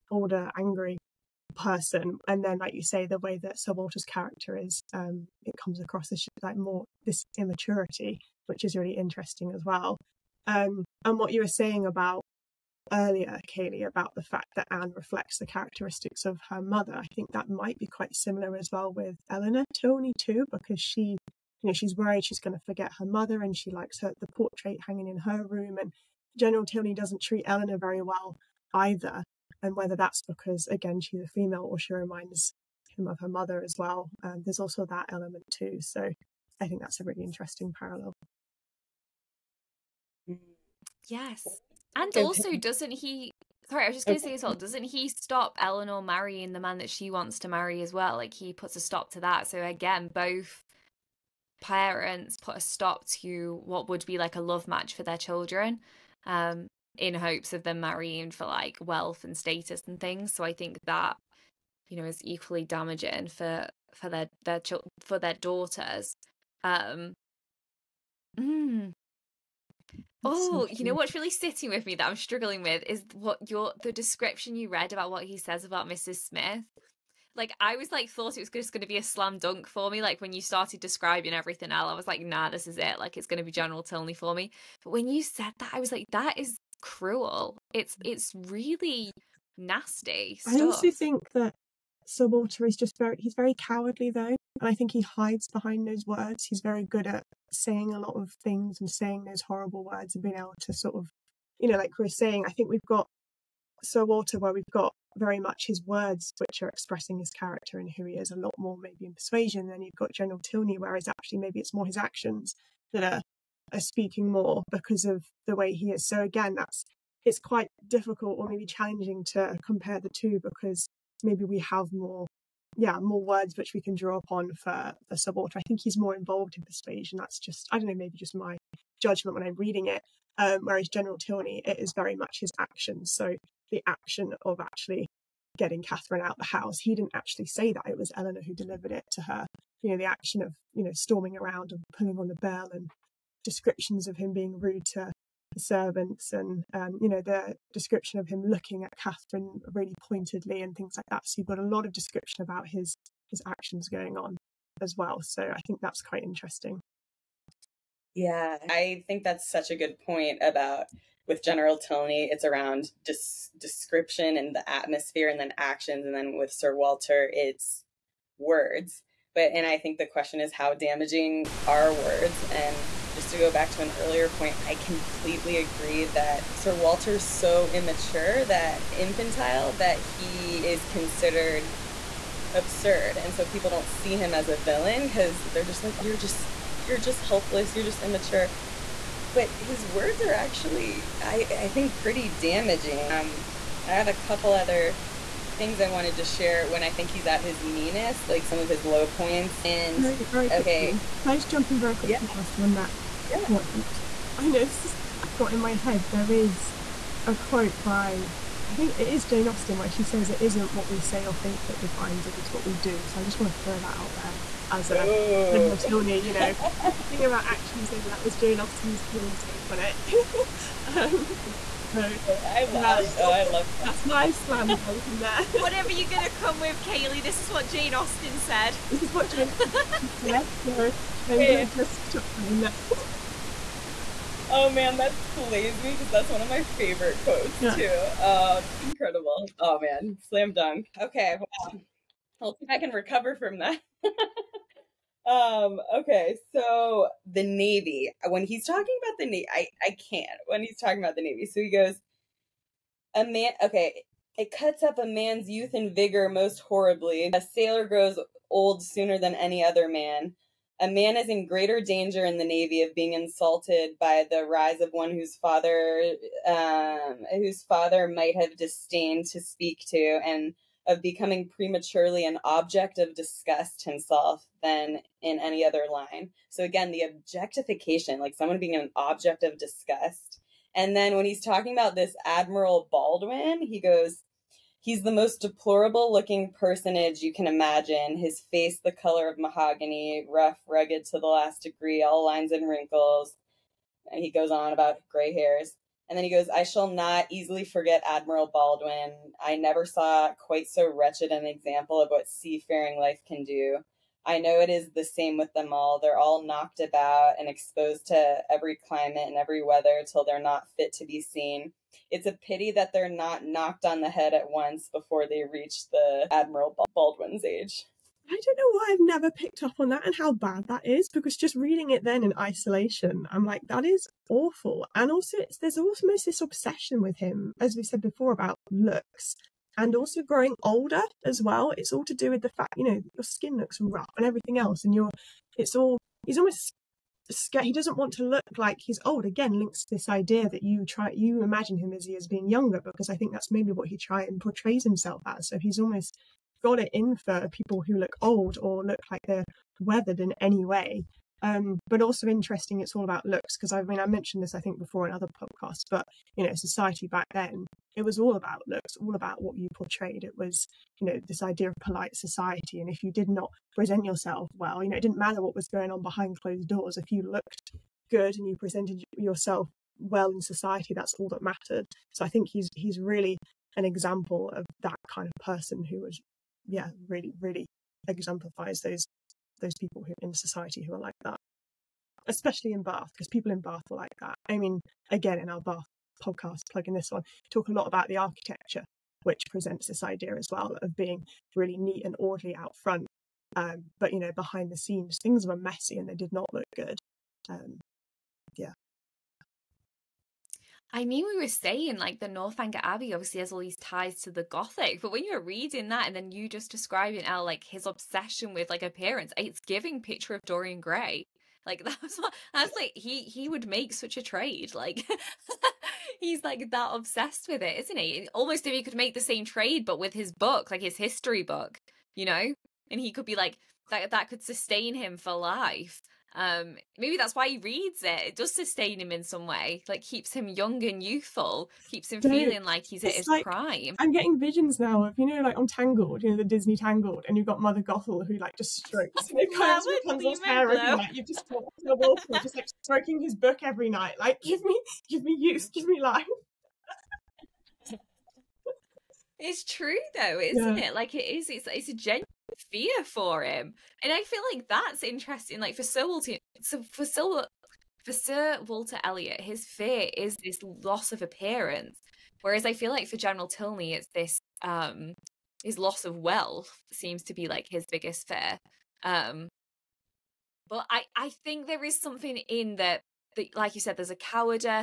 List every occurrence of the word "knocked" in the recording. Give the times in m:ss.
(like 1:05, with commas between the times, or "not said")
5:06, 5:13.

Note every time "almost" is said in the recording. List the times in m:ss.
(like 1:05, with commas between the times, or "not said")
5:25, 5:36, 5:45, 6:58.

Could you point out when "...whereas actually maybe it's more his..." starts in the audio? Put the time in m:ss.
1:50.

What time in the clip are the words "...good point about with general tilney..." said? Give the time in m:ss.
2:39.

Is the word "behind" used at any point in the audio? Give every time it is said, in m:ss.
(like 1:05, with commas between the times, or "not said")
1:35, 6:06, 6:34.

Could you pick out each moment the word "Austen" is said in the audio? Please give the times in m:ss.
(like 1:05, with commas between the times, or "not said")
3:29, 3:38, 3:47.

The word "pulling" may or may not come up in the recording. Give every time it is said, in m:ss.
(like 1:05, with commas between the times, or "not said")
2:21.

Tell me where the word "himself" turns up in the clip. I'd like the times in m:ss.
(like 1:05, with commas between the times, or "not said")
4:33, 5:44.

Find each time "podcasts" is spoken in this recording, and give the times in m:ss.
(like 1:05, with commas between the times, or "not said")
5:55, 6:26.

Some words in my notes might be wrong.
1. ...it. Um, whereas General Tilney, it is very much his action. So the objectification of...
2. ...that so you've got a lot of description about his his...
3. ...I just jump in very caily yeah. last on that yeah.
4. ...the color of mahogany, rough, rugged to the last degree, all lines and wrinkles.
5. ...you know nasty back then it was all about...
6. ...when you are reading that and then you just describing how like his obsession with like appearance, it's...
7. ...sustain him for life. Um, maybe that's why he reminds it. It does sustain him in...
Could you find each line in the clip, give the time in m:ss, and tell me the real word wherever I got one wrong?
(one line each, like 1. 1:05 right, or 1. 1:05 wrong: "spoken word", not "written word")
1. 2:09 wrong: "action", not "objectification"
2. 2:31 right
3. 3:21 wrong: "quickly", not "caily"
4. 4:48 right
5. 5:56 wrong: "society", not "nasty"
6. 6:45 right
7. 7:04 wrong: "reads", not "reminds".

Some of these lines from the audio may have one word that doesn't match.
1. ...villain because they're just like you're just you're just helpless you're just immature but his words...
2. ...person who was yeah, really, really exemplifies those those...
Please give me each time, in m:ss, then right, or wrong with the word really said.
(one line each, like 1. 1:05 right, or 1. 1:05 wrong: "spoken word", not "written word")
1. 3:04 right
2. 6:15 right.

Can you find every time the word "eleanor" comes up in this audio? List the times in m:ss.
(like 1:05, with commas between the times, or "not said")
0:19, 0:27, 0:45, 2:18.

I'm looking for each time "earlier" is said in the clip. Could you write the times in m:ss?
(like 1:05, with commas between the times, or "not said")
0:12, 2:53.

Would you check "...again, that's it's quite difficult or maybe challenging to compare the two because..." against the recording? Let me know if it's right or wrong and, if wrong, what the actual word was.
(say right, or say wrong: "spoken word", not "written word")
right.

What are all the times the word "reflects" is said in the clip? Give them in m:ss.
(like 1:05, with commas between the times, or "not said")
0:14.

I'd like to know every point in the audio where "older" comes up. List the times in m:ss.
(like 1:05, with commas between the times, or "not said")
0:00, 5:30.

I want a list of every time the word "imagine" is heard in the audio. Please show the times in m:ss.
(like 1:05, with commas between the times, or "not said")
4:47, 5:41.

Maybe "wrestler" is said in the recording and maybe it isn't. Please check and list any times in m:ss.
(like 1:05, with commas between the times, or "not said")
not said.